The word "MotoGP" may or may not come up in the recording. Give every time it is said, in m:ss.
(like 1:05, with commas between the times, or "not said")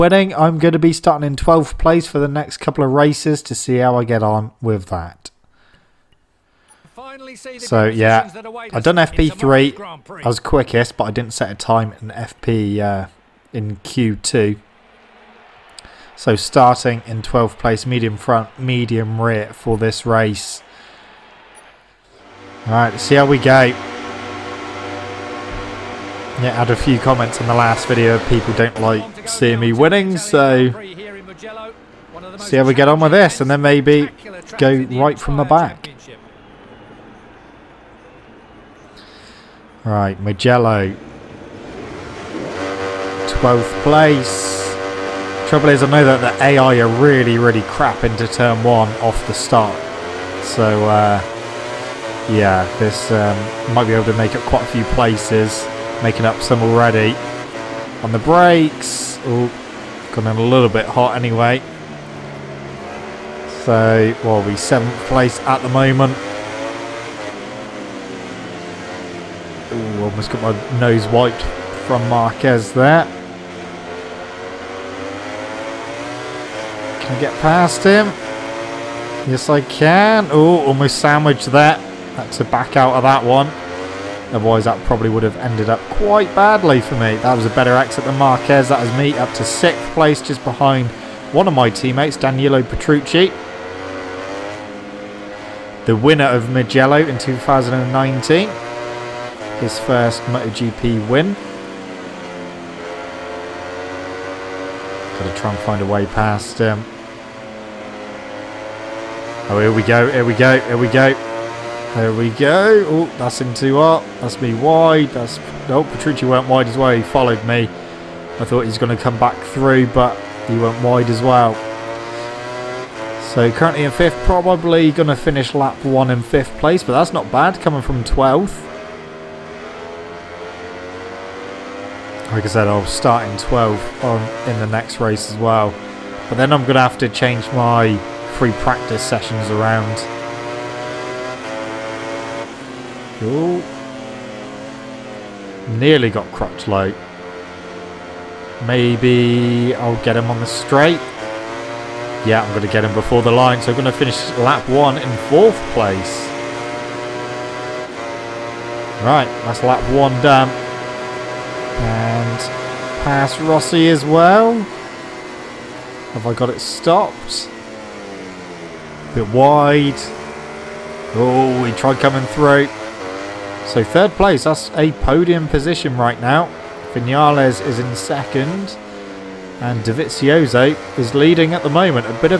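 1:40.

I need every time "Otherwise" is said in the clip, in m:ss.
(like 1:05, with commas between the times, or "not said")
1:24.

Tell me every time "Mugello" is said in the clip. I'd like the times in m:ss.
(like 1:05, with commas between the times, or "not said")
0:40, 1:36.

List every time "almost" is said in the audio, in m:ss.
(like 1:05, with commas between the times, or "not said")
1:10, 1:20.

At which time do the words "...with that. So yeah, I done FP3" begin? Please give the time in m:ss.
0:04.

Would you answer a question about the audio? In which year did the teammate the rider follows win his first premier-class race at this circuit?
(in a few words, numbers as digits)
2019.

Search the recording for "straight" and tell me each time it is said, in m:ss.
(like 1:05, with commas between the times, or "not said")
2:30.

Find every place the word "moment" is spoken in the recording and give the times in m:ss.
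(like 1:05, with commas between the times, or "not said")
1:05, 3:01.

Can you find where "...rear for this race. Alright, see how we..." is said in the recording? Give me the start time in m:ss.
0:19.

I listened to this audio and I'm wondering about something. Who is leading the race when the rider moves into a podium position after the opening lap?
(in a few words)
Dovizioso.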